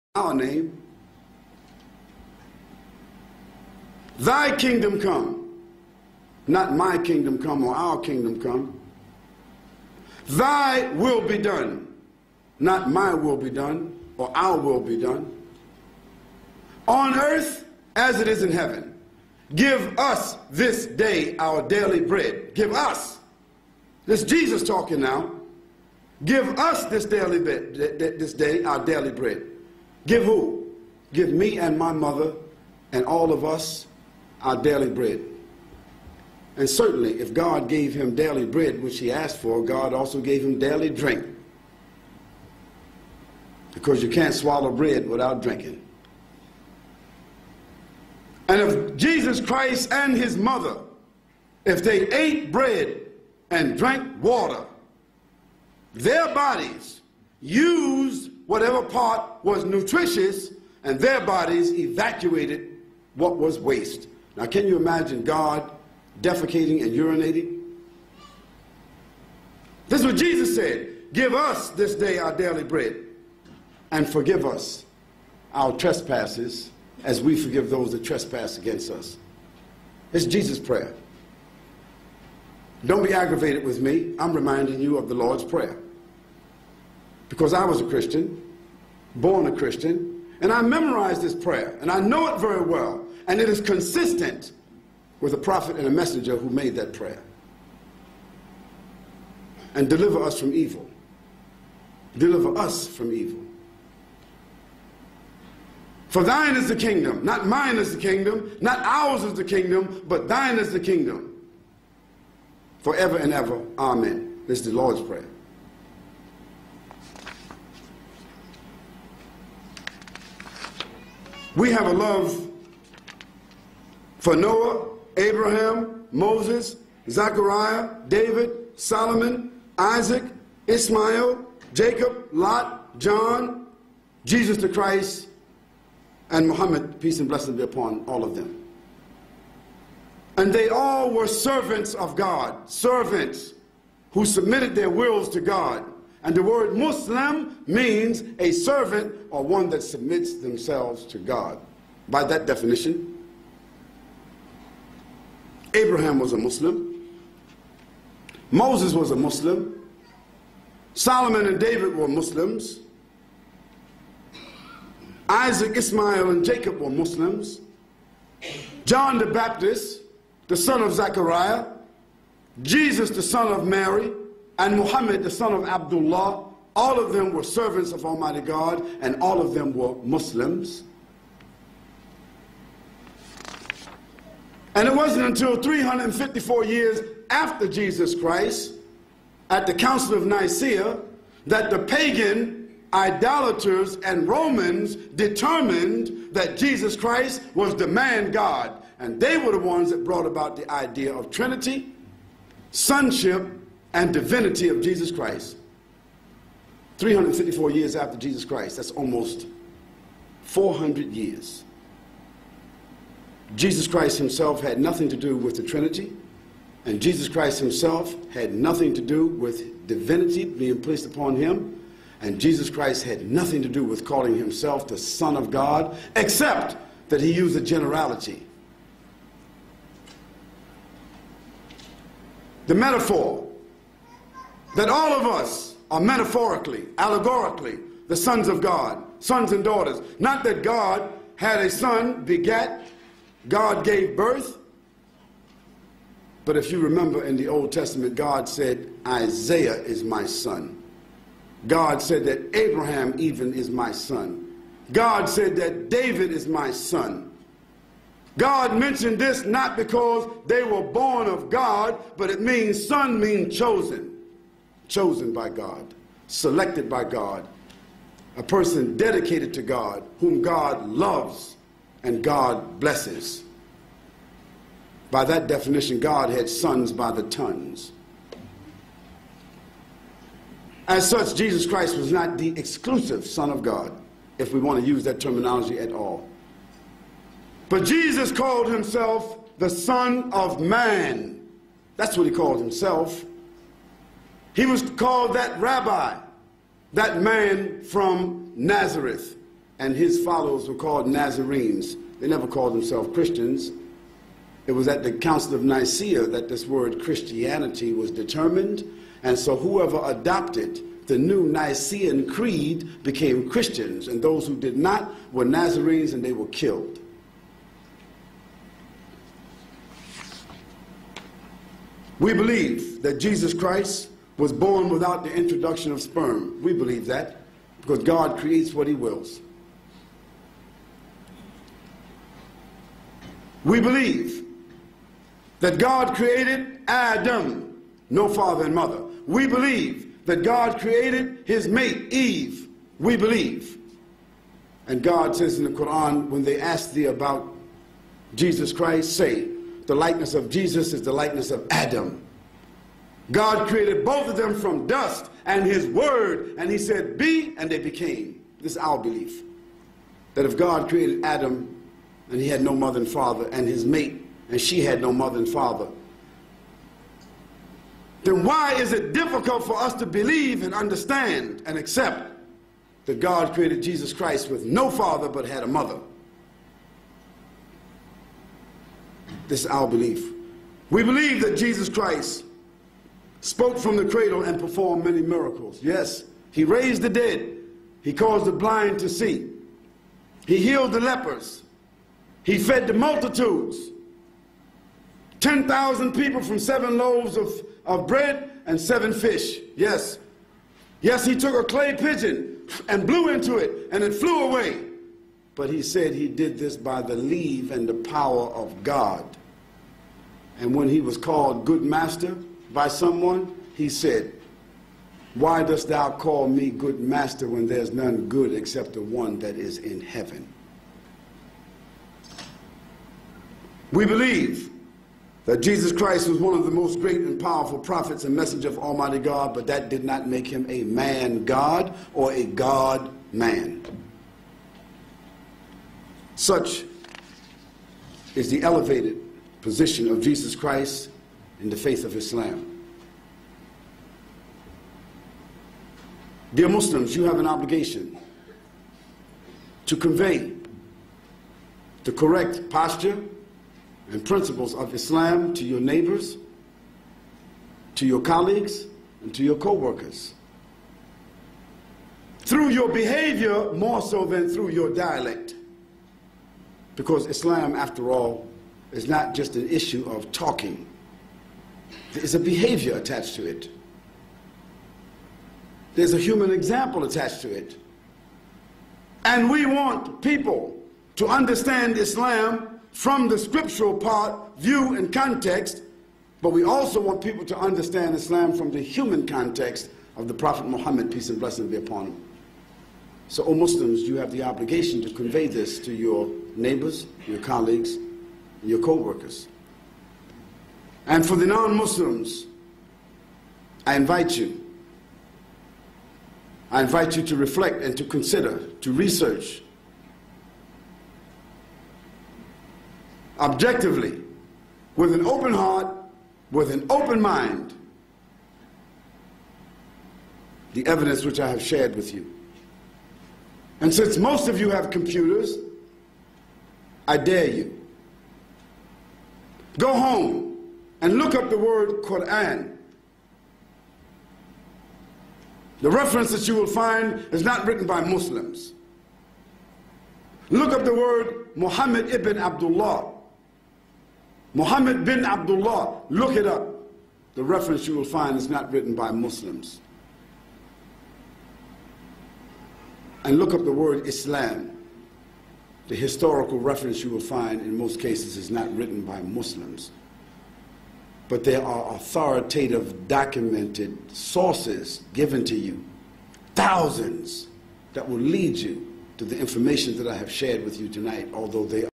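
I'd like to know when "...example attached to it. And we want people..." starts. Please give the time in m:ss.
7:56.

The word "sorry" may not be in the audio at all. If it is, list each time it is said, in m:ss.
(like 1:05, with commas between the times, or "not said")
not said.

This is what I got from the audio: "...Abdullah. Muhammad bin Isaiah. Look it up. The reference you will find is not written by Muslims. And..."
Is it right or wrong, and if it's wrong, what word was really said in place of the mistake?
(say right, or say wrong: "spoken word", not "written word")
wrong: "Abdullah", not "Isaiah".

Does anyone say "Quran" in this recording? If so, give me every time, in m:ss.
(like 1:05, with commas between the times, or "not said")
5:45, 8:52.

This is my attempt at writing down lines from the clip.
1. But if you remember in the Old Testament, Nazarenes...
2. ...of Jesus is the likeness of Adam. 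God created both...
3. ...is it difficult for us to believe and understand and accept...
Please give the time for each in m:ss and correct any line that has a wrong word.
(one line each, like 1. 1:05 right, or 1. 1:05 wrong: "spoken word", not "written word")
1. 4:06 wrong: "God", not "Nazarenes"
2. 5:50 right
3. 6:08 right.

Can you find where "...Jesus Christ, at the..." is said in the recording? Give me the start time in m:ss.
3:07.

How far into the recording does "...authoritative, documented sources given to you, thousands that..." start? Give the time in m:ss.
9:21.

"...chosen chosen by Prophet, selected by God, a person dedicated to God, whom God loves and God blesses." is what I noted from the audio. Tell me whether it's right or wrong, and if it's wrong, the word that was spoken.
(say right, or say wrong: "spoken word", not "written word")
wrong: "God", not "Prophet".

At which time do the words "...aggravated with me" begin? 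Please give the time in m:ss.
1:23.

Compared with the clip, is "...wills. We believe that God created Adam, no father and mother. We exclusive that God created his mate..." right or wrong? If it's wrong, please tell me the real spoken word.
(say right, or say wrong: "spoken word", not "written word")
wrong: "believe", not "exclusive".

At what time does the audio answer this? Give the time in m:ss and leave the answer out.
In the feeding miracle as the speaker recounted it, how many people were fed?
6:35.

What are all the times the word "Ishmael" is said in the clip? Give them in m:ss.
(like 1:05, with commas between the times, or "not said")
2:10, 2:45.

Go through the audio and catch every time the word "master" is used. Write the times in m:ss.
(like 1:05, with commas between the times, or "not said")
6:51, 6:56.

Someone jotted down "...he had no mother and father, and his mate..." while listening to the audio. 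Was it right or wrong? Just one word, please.
right.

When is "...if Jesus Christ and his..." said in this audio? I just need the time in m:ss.
0:48.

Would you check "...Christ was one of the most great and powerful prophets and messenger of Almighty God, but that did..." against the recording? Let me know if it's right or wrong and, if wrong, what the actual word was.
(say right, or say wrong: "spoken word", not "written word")
right.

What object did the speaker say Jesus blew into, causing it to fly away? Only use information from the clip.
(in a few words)
clay pigeon.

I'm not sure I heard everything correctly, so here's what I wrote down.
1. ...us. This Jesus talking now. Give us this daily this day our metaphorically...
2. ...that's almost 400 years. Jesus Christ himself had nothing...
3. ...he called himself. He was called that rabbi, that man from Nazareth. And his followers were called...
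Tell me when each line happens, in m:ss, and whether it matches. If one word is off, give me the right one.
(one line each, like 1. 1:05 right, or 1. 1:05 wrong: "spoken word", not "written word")
1. 0:22 wrong: "daily", not "metaphorically"
2. 3:28 right
3. 4:52 right.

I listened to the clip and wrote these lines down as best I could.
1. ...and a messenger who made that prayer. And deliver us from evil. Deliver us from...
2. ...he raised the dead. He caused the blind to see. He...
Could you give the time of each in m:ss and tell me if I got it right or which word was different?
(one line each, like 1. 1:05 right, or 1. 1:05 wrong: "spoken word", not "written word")
1. 1:35 right
2. 6:26 right.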